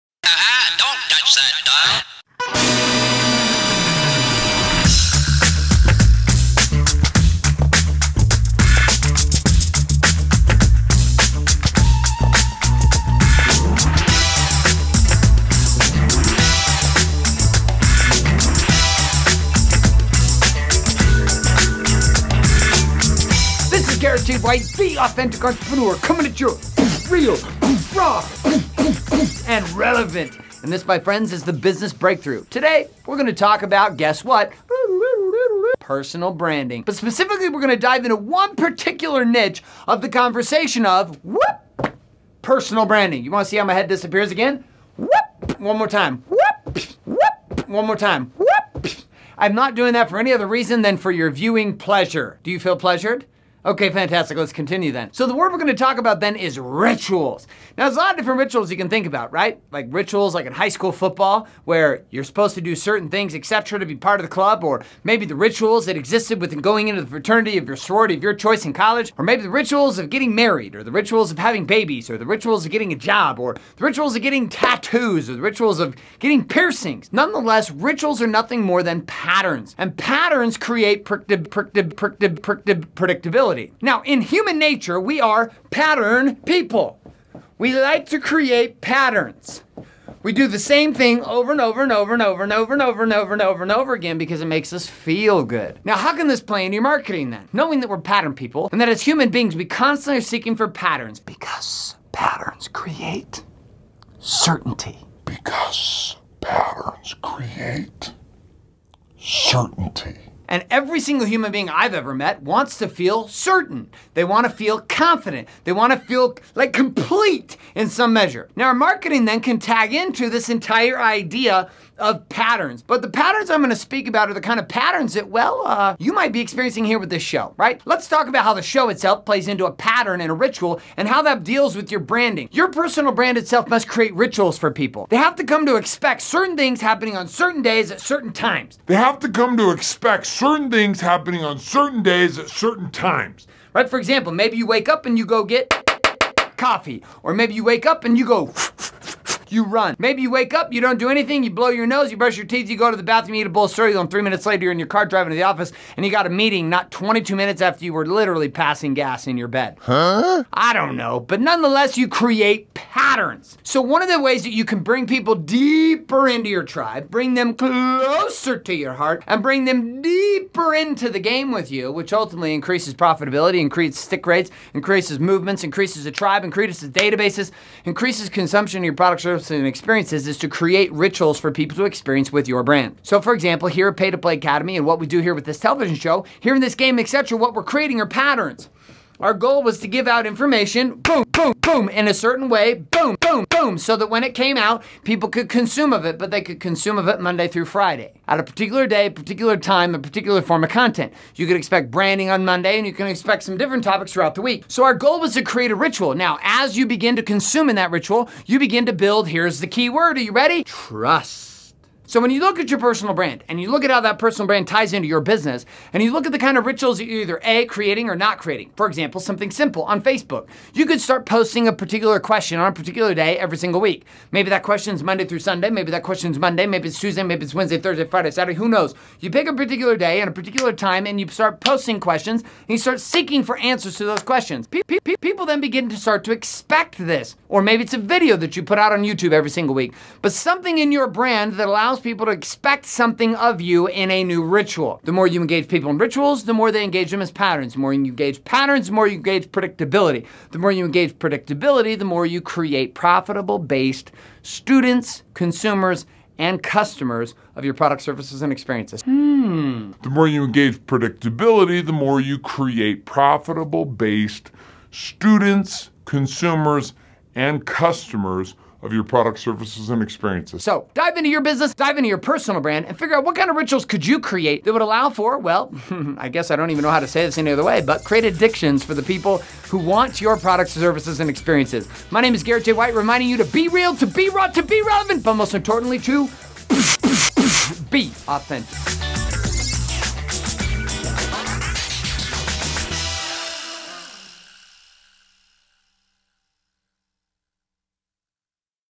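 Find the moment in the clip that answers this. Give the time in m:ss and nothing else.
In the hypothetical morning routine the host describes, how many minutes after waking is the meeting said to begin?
2:36.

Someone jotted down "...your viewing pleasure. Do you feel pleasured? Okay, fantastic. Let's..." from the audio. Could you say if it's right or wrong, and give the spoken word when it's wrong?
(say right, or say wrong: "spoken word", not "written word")
right.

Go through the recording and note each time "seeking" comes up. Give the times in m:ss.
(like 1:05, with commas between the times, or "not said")
1:40, 3:52.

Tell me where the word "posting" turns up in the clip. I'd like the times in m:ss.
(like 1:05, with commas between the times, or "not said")
3:41, 3:51.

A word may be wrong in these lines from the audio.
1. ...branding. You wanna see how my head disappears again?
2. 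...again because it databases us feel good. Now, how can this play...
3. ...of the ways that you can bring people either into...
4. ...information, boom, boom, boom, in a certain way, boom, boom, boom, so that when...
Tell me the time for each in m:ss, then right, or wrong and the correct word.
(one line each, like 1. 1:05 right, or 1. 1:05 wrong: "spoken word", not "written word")
1. 0:42 right
2. 1:33 wrong: "makes", not "databases"
3. 2:44 wrong: "deeper", not "either"
4. 3:10 right.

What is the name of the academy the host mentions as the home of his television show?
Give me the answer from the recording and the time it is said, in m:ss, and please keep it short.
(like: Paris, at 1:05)
Paid to Play Academy, at 3:03.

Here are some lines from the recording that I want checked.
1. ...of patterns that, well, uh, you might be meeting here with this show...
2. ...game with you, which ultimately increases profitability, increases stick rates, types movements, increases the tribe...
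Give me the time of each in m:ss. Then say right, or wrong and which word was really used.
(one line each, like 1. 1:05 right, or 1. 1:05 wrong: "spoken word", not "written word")
1. 2:04 wrong: "experiencing", not "meeting"
2. 2:51 wrong: "increases", not "types".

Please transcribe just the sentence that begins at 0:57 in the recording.
Now, there's a lot of different rituals you can think about, right?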